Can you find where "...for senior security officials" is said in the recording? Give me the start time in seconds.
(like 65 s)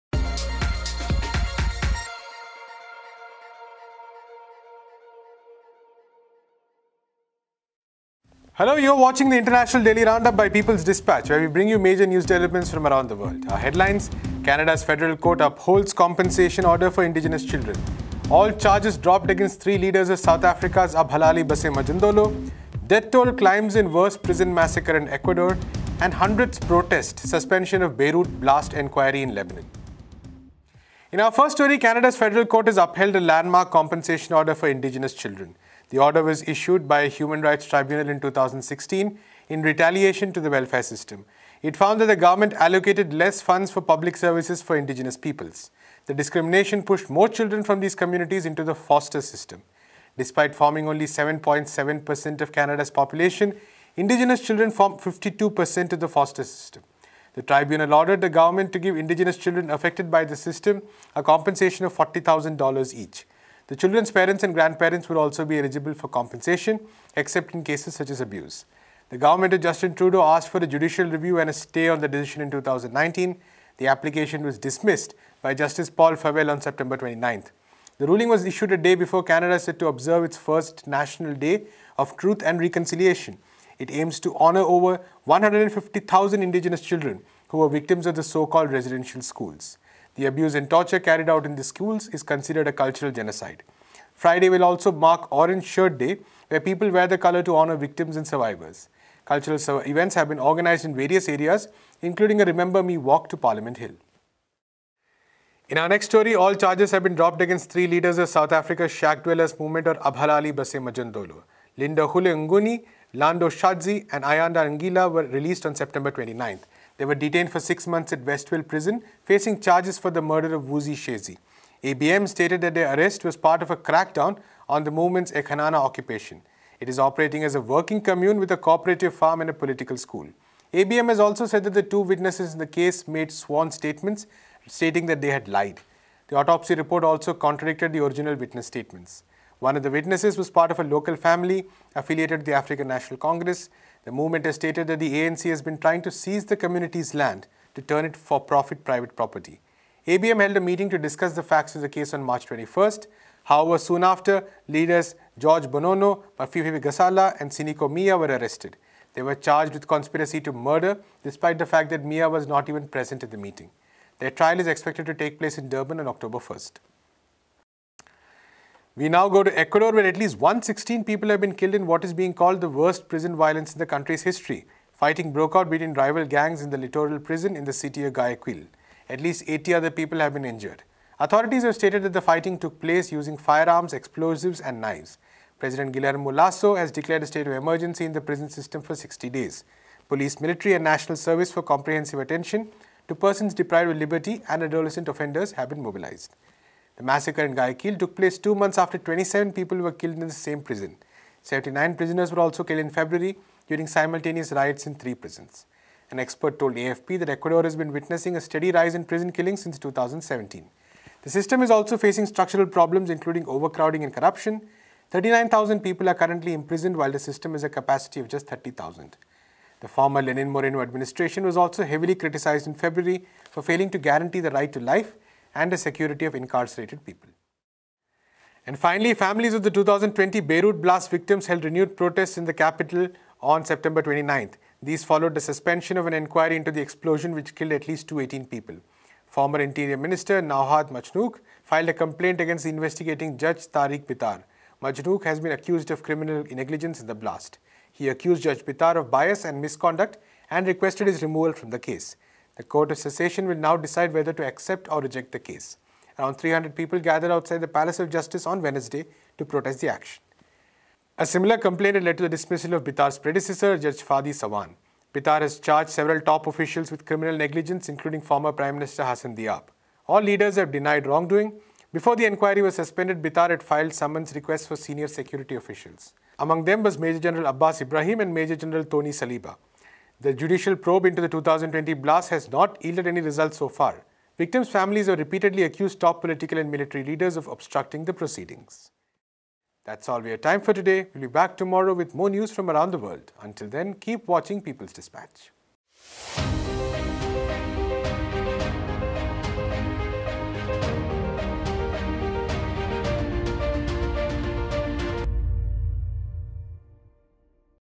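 274 s.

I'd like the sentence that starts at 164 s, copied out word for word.
Their trial is expected to take place in Durban on October 1st.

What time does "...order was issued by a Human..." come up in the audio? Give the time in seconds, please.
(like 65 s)
35 s.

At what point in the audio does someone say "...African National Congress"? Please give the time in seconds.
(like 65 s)
142 s.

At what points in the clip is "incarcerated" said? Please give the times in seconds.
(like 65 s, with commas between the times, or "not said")
226 s.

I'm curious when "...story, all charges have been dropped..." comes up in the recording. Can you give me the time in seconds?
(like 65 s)
106 s.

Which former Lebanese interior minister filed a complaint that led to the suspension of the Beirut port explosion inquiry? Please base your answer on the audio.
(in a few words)
Nohad Machnouk.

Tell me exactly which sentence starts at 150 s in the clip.
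ABM held a meeting to discuss the facts of the case on March 21st.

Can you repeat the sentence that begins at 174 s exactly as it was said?
Fighting broke out between rival gangs in the Litoral prison in the city of Guayaquil.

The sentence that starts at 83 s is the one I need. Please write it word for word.
It aims to honor over 150,000 Indigenous children who were victims of the so-called residential schools.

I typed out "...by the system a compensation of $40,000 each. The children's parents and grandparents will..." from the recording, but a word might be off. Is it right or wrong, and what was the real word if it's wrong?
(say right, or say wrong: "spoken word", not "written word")
right.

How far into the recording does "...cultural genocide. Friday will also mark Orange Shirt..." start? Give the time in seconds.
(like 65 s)
92 s.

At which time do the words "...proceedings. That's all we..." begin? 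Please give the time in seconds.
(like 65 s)
288 s.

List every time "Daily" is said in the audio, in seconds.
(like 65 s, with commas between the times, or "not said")
9 s.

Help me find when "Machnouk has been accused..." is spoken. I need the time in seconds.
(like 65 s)
244 s.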